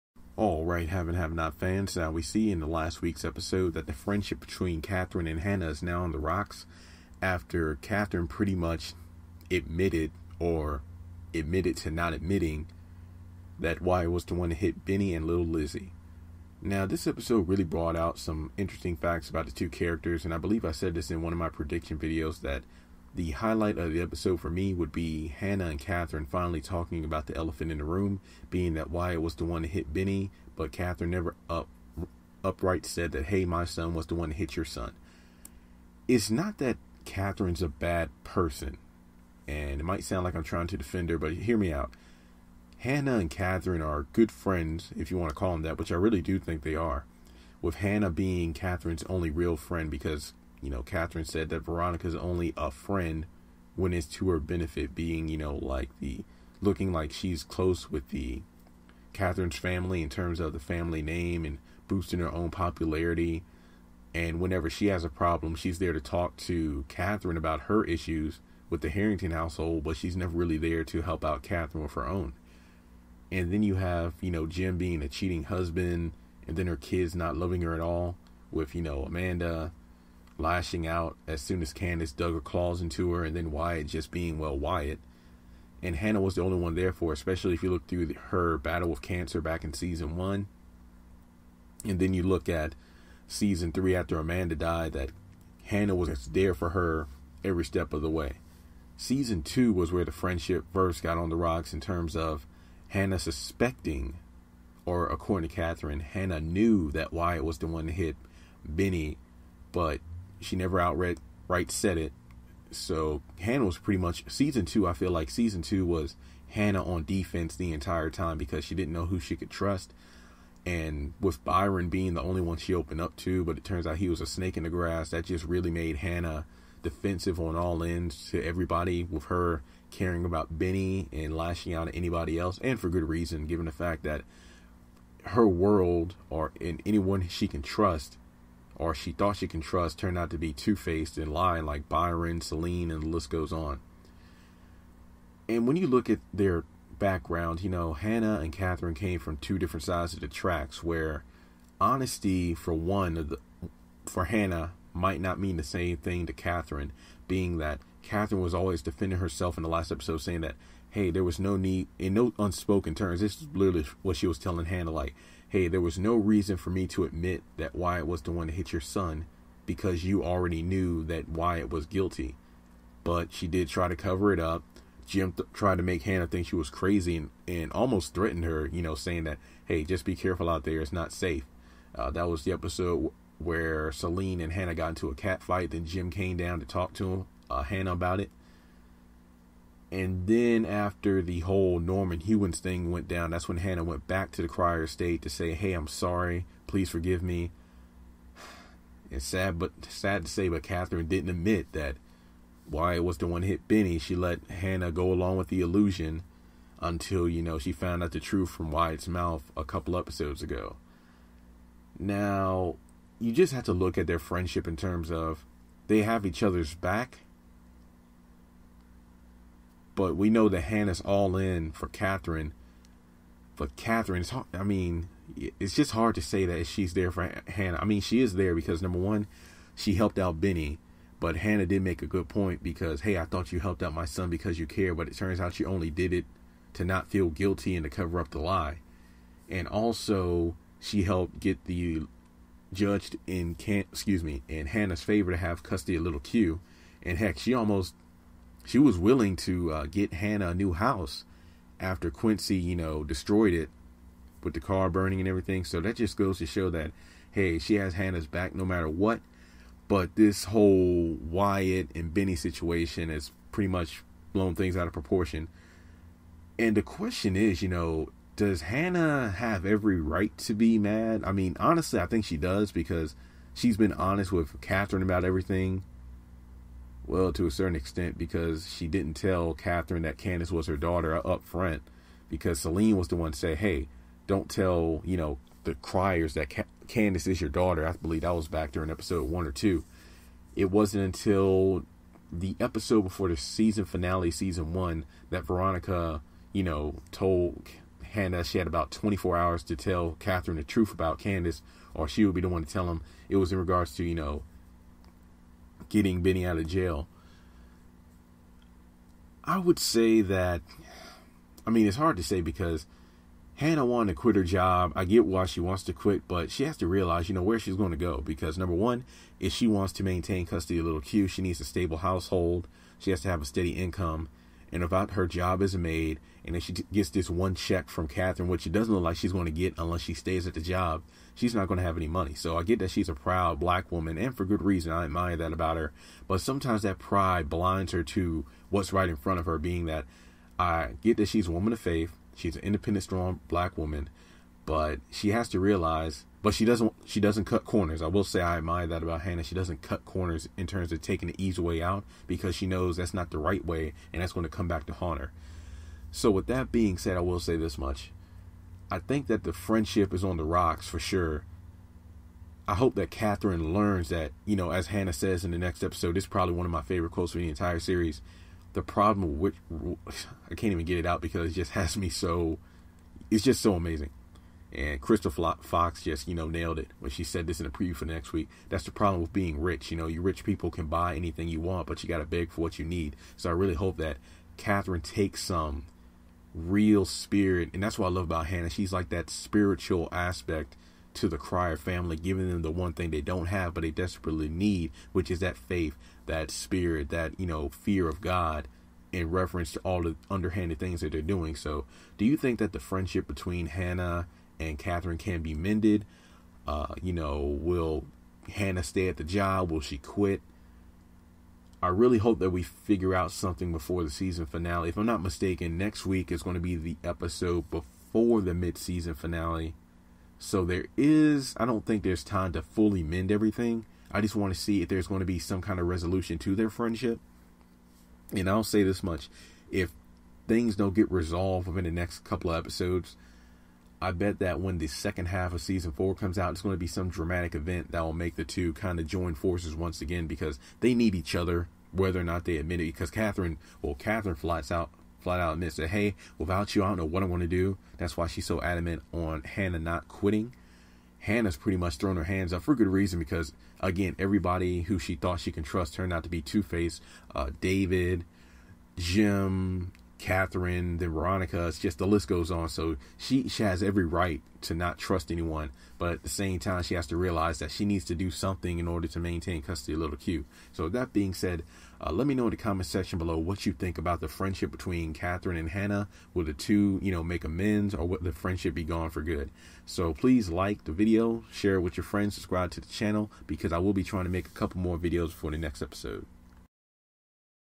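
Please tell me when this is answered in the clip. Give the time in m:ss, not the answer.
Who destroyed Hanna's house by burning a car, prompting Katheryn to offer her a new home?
4:12.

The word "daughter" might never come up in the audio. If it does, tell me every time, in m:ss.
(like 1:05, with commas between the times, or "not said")
4:40, 4:47.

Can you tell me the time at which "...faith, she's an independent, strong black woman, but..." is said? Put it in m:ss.
5:41.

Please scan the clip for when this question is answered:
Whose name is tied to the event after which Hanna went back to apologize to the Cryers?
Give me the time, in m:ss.
3:11.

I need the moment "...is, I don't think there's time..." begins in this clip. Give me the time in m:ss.
7:00.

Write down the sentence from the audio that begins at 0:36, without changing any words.
It's not that Katheryn's a bad person, and it might sound like I'm trying to defend her, but hear me out.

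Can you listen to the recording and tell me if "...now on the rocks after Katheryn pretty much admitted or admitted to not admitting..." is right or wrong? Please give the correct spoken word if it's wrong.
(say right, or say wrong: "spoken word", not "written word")
right.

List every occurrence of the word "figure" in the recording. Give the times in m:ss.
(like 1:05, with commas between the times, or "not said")
6:52.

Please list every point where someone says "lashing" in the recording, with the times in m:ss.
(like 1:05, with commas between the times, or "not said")
1:20, 2:11.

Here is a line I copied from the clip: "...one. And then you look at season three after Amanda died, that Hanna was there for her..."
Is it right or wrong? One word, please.
right.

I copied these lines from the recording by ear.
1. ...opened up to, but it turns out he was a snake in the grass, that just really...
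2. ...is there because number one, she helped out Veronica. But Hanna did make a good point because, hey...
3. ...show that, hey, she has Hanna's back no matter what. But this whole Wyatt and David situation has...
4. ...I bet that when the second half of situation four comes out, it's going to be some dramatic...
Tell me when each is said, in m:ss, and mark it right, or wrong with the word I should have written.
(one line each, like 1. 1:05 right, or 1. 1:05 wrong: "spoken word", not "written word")
1. 2:02 right
2. 3:48 wrong: "Benny", not "Veronica"
3. 4:16 wrong: "Benny", not "David"
4. 7:14 wrong: "season", not "situation".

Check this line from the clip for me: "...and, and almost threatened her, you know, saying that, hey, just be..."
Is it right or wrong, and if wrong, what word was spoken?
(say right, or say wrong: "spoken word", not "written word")
right.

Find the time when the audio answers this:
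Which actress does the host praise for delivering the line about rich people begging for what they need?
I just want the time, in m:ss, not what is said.
6:15.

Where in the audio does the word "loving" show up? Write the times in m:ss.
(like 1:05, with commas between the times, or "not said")
1:17.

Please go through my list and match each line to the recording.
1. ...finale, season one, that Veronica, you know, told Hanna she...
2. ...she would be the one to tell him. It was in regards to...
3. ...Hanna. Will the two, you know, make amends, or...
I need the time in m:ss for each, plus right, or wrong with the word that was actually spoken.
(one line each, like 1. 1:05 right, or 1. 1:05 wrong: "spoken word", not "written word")
1. 4:53 right
2. 5:02 right
3. 7:55 right.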